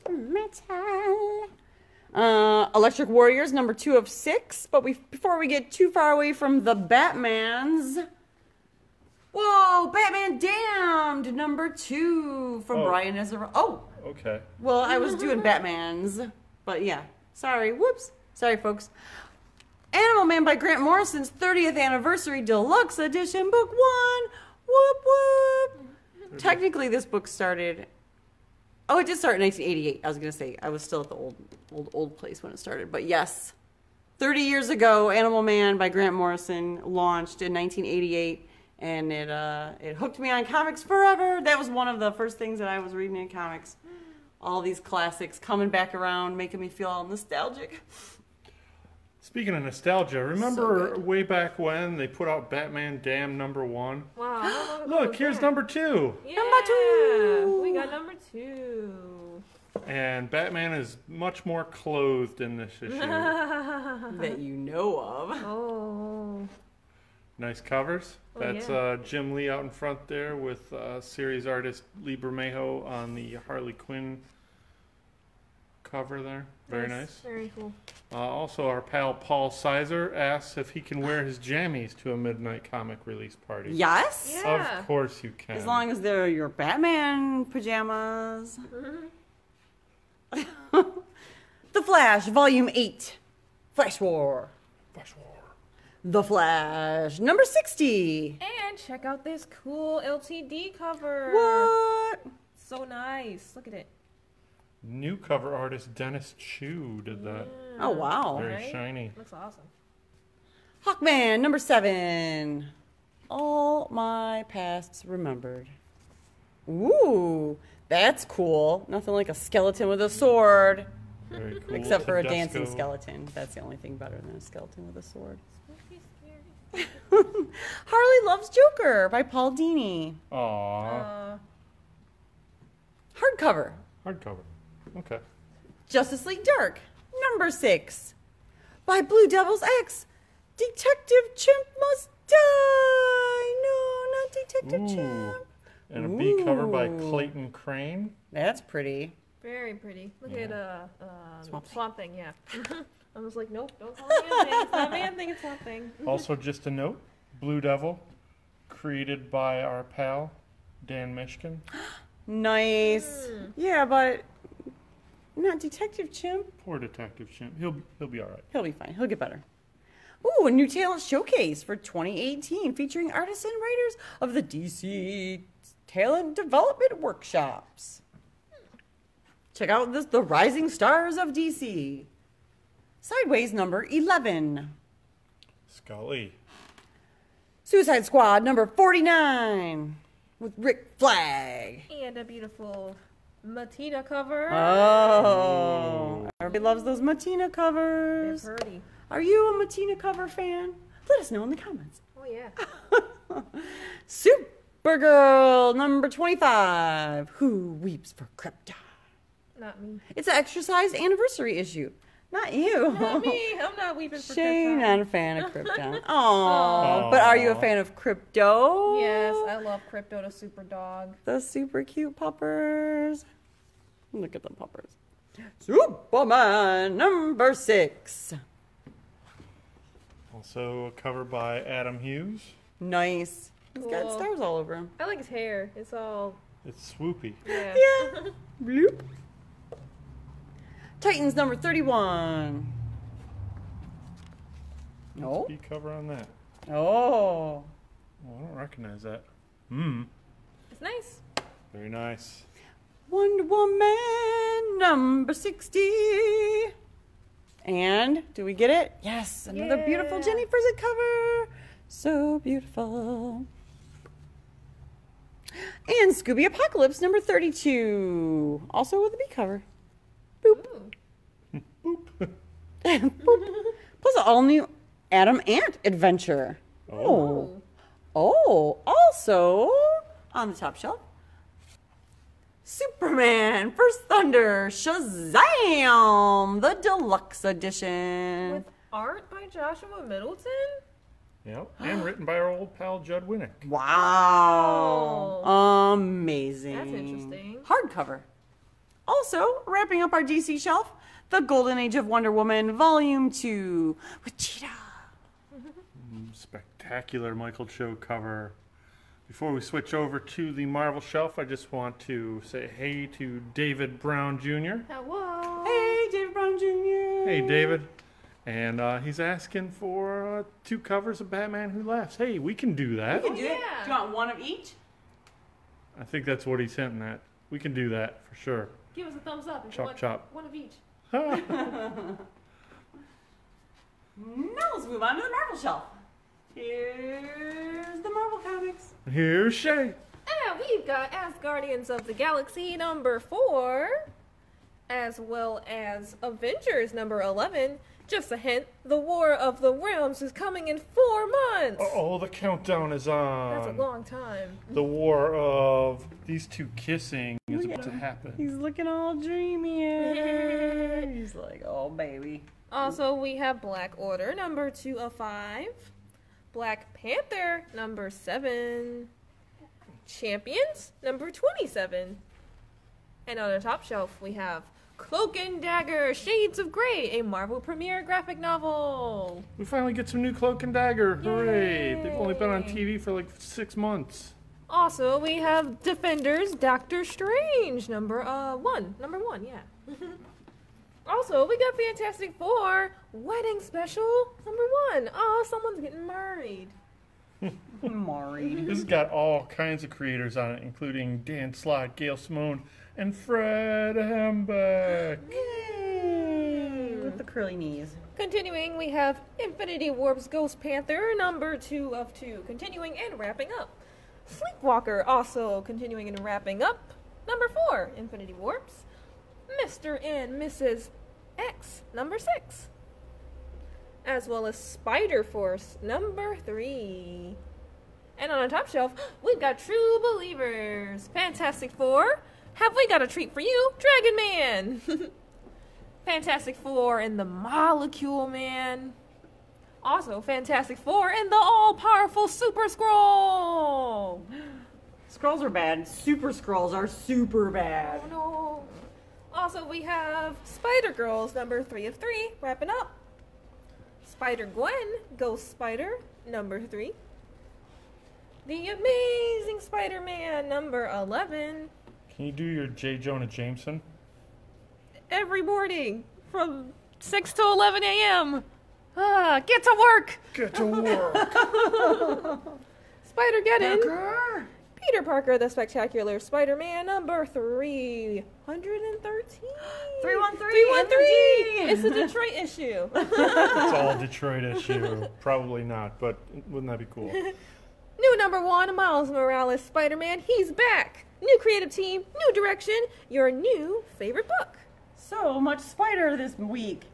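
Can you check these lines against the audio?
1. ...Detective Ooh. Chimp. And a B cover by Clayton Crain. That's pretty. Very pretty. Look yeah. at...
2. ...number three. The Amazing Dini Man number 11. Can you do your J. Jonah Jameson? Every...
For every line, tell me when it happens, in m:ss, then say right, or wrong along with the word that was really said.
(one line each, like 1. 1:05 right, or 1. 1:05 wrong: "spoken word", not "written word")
1. 2:24 right
2. 7:36 wrong: "Spider", not "Dini".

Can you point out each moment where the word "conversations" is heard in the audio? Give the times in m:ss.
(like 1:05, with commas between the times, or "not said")
not said.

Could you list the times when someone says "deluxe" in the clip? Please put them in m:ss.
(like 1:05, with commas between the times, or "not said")
0:22, 4:46.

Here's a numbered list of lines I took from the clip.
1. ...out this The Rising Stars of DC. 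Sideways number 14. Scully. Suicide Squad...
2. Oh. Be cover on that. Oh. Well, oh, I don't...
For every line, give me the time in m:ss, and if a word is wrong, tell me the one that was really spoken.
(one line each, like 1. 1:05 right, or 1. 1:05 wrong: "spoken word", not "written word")
1. 2:59 wrong: "11", not "14"
2. 4:05 right.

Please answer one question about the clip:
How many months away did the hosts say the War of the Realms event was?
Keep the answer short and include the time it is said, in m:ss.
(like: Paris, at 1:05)
4, at 5:50.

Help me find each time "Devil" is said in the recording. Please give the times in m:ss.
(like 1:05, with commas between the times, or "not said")
2:19, 2:37.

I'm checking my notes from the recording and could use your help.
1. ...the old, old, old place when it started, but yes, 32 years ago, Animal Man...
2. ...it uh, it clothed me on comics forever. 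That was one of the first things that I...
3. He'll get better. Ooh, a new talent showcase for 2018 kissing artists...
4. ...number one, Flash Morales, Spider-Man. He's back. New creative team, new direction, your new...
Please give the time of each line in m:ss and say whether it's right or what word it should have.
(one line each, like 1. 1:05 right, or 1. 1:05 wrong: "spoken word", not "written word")
1. 0:31 wrong: "30", not "32"
2. 0:39 wrong: "hooked", not "clothed"
3. 2:48 wrong: "featuring", not "kissing"
4. 8:08 wrong: "Miles", not "Flash".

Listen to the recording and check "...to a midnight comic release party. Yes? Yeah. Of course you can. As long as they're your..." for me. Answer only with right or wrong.
right.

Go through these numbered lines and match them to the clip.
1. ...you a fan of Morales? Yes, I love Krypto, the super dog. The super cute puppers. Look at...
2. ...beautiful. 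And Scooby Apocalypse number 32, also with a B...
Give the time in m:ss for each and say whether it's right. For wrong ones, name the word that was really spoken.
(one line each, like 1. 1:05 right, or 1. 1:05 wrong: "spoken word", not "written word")
1. 3:37 wrong: "Krypto", not "Morales"
2. 4:22 right.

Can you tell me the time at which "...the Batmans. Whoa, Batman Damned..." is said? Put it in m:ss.
0:06.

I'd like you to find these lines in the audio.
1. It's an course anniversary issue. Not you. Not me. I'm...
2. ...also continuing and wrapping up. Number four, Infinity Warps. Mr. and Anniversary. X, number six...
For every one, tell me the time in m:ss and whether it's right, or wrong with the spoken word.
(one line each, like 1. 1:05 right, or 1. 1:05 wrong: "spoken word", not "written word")
1. 3:30 wrong: "exercise", not "course"
2. 6:55 wrong: "Mrs", not "Anniversary".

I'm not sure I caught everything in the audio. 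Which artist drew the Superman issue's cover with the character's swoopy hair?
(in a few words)
Adam Hughes.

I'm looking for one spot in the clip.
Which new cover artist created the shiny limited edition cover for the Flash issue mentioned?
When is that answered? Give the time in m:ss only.
1:45.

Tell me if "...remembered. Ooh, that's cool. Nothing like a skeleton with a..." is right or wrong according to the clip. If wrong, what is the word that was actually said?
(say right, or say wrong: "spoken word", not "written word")
right.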